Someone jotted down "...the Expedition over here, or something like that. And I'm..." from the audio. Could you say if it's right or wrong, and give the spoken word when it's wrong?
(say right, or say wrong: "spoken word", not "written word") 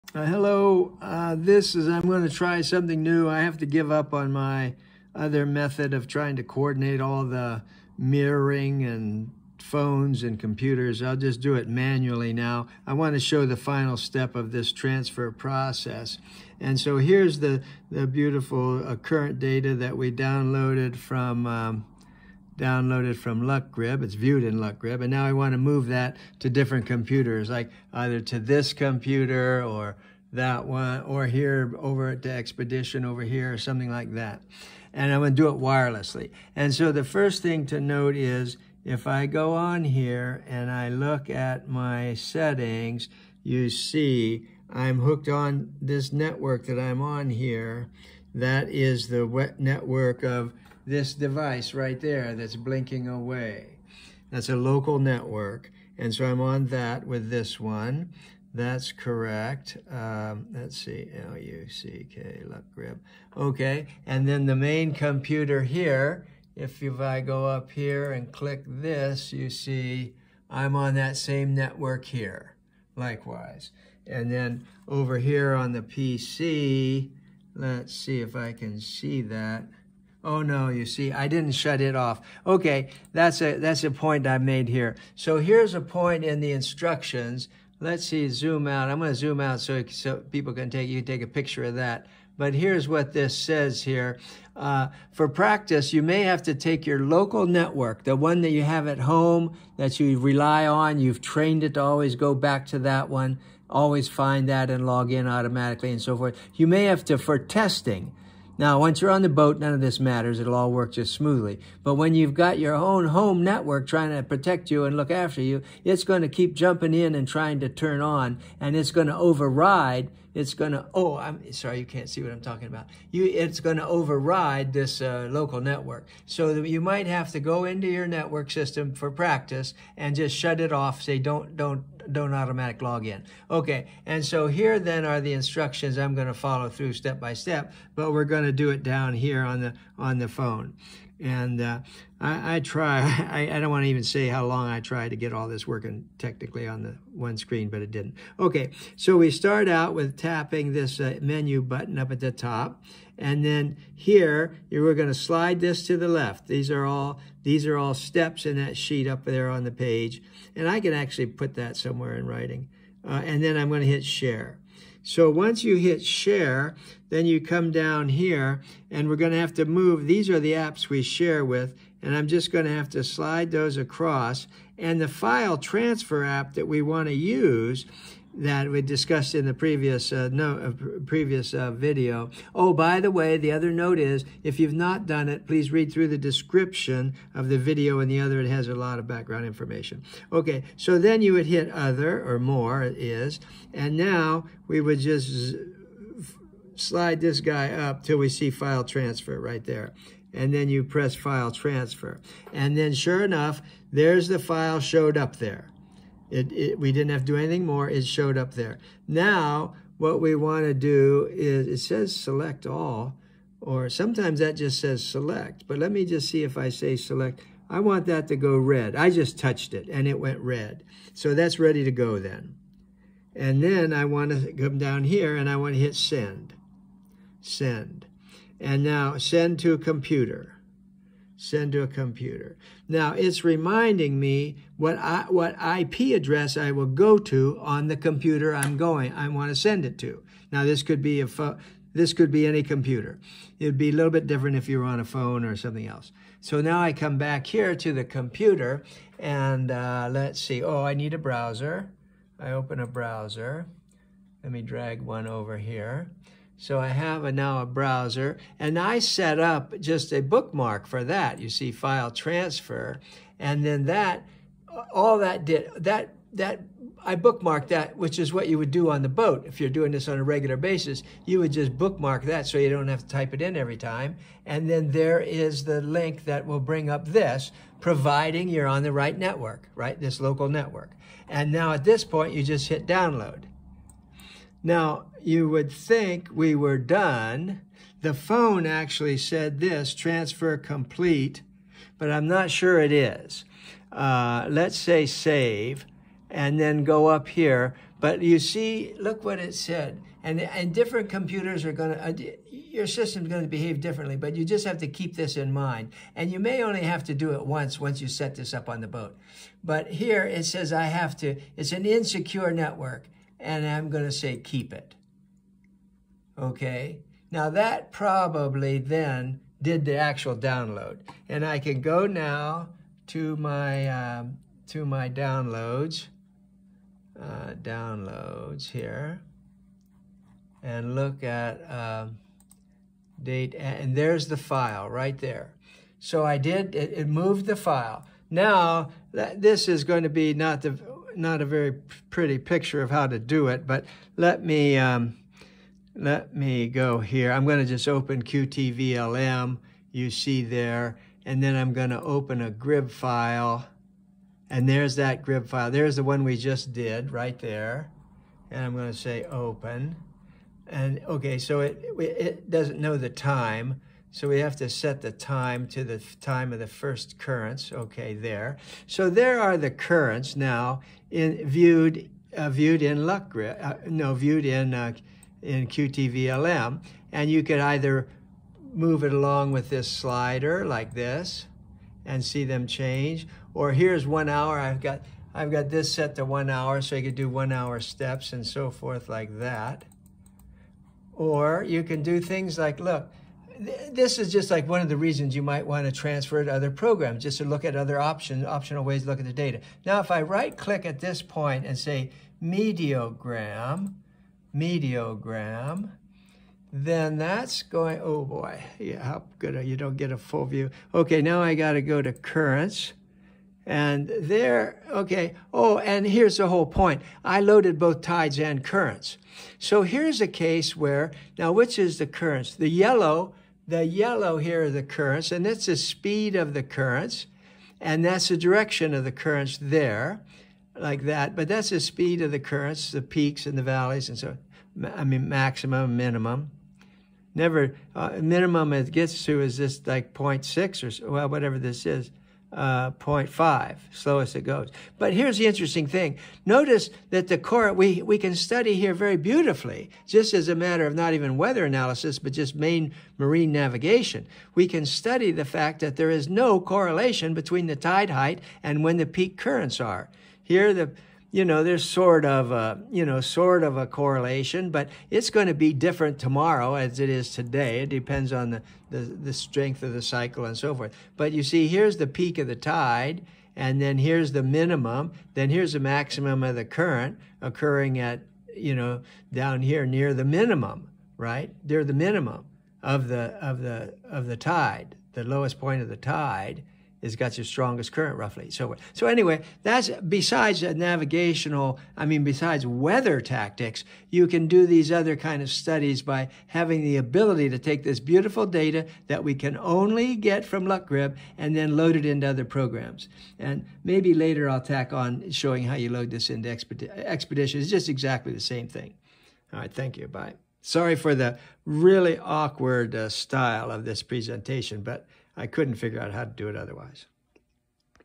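right.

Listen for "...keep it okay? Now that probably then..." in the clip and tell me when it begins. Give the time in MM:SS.
05:14.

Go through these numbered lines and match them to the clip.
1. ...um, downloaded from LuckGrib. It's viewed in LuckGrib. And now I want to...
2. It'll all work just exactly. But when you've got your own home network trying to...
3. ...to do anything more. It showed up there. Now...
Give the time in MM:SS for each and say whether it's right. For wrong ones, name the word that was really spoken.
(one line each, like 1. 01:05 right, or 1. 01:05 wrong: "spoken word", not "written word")
1. 00:21 right
2. 01:50 wrong: "smoothly", not "exactly"
3. 03:27 right.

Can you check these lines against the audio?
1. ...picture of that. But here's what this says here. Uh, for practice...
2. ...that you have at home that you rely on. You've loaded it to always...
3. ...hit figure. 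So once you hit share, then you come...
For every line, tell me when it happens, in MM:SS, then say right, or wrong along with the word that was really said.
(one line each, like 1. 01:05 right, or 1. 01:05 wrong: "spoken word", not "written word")
1. 01:31 right
2. 01:38 wrong: "trained", not "loaded"
3. 02:43 wrong: "share", not "figure".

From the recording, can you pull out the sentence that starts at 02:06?
So you might have to go into your network system for practice and just shut it off.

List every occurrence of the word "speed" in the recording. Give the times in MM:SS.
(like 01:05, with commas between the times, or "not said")
07:05, 07:11.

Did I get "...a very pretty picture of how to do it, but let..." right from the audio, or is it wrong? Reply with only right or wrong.
right.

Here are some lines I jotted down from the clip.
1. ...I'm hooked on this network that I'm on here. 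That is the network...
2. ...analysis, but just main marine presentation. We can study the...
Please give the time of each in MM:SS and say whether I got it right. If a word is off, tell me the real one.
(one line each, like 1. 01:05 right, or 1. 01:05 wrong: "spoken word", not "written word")
1. 00:44 right
2. 07:31 wrong: "navigation", not "presentation".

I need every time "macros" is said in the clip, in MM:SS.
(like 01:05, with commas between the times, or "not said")
not said.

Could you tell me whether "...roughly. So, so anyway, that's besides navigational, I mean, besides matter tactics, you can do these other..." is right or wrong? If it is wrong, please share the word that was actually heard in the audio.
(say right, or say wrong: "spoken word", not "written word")
wrong: "weather", not "matter".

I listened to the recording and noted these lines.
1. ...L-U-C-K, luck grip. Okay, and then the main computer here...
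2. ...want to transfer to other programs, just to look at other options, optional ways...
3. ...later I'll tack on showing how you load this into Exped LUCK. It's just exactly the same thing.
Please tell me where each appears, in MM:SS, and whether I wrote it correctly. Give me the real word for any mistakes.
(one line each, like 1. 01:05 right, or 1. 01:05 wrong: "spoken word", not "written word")
1. 01:01 right
2. 06:35 right
3. 08:24 wrong: "Expedition", not "LUCK".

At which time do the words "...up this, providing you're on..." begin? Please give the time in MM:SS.
04:36.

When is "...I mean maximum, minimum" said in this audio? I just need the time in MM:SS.
07:14.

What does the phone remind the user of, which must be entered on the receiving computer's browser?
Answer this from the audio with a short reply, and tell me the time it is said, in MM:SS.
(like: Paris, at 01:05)
IP address, at 03:55.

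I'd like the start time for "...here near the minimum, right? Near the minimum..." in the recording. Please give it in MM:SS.
07:59.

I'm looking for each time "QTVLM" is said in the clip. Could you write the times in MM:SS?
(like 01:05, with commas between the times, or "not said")
05:48, 06:15.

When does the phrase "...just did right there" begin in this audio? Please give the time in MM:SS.
05:56.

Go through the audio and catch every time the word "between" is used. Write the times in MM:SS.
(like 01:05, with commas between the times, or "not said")
07:37.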